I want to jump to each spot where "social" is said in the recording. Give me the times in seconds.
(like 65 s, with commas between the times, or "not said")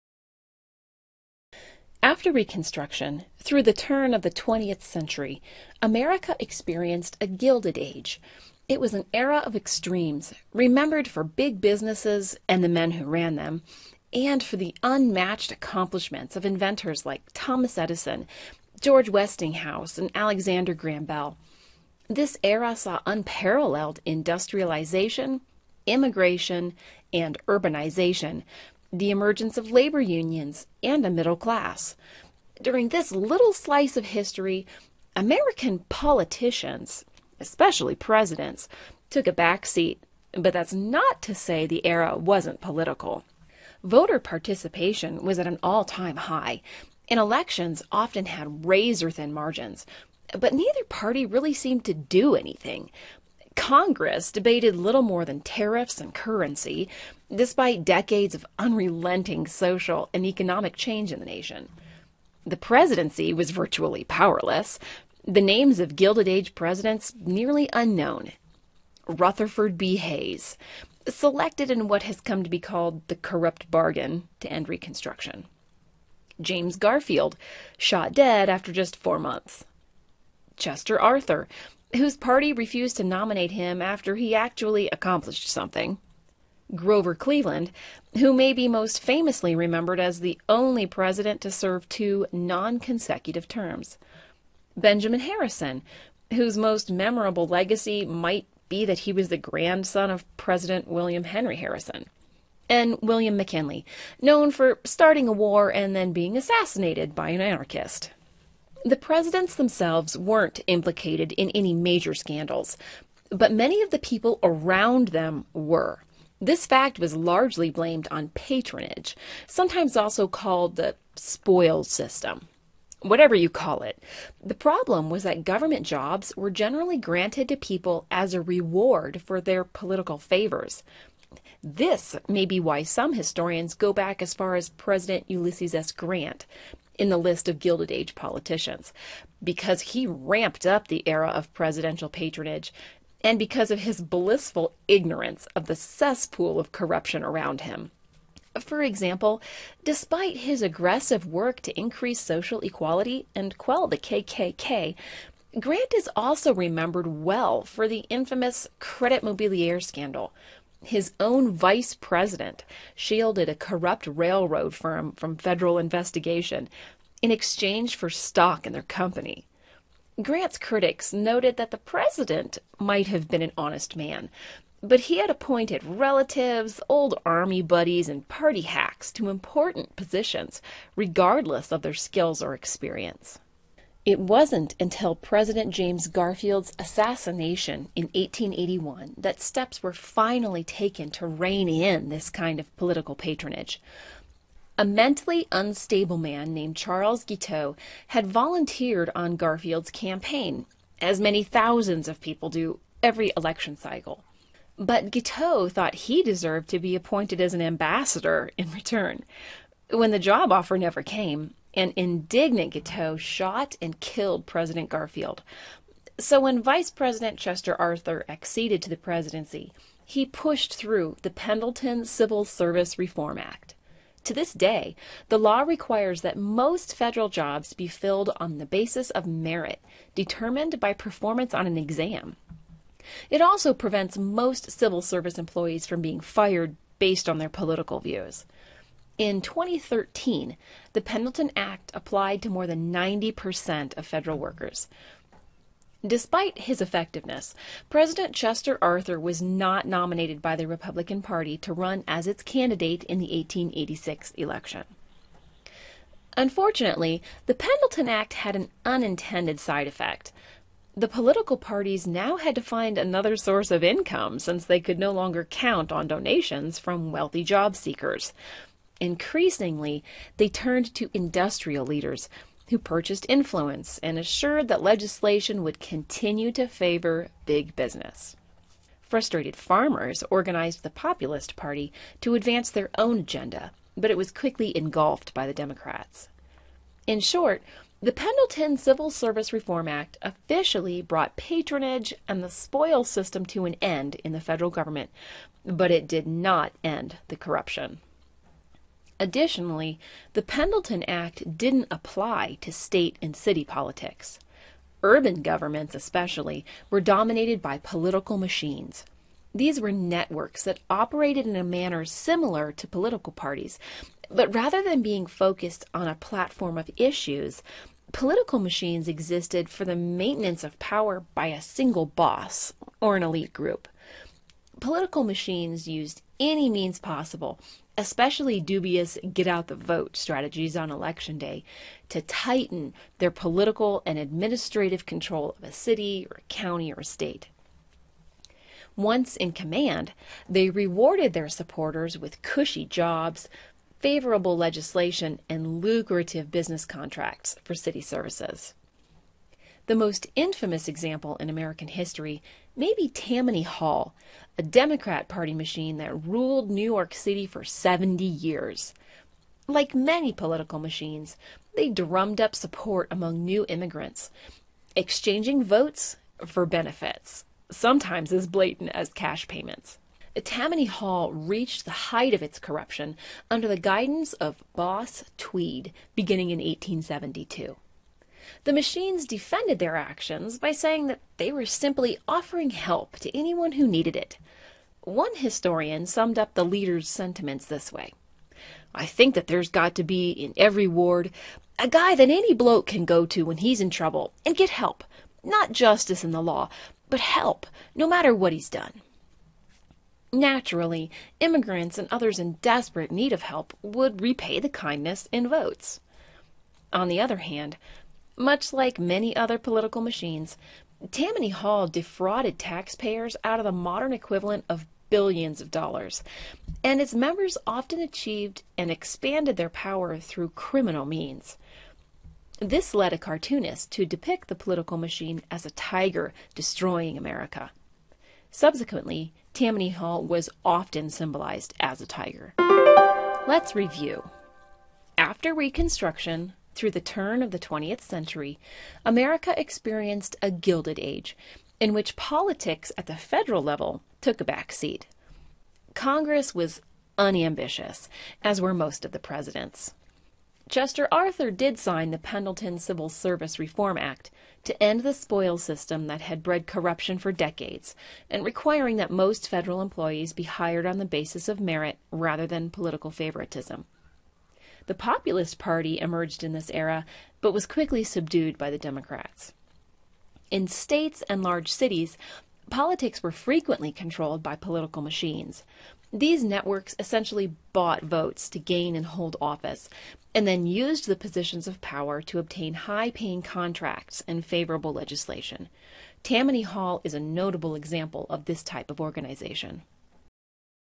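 59 s, 152 s.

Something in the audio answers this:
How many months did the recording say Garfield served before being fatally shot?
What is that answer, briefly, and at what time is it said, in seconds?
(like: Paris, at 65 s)
4, at 78 s.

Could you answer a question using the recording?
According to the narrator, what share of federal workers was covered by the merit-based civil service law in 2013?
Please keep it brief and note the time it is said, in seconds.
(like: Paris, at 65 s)
More than 90%, at 242 s.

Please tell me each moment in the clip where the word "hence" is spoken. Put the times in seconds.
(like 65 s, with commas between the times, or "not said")
not said.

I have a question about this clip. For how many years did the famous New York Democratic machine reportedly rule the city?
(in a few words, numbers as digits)
70.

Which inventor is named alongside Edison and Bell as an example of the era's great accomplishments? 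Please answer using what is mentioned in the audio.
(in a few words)
George Westinghouse.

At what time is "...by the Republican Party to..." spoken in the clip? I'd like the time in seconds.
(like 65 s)
250 s.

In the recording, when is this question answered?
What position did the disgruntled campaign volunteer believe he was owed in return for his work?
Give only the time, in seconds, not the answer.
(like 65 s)
207 s.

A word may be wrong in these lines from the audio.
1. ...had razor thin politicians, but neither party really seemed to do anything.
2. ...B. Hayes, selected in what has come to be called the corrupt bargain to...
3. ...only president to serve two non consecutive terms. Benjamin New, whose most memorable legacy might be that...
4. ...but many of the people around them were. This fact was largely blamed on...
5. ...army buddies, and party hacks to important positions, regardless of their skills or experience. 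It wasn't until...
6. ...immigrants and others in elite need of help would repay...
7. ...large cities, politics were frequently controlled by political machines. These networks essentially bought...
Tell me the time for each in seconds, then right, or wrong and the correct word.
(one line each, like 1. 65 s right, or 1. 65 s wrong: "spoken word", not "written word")
1. 48 s wrong: "margins", not "politicians"
2. 69 s right
3. 90 s wrong: "Harrison", not "New"
4. 113 s right
5. 177 s right
6. 401 s wrong: "desperate", not "elite"
7. 471 s right.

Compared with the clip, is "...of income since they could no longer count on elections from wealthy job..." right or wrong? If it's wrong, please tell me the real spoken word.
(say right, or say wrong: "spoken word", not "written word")
wrong: "donations", not "elections".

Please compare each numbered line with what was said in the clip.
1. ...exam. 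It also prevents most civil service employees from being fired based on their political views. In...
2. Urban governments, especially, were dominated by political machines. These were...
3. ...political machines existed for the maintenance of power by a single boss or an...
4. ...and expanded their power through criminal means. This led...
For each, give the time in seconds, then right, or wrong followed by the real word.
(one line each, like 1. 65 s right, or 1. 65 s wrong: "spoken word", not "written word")
1. 231 s right
2. 305 s right
3. 318 s right
4. 418 s right.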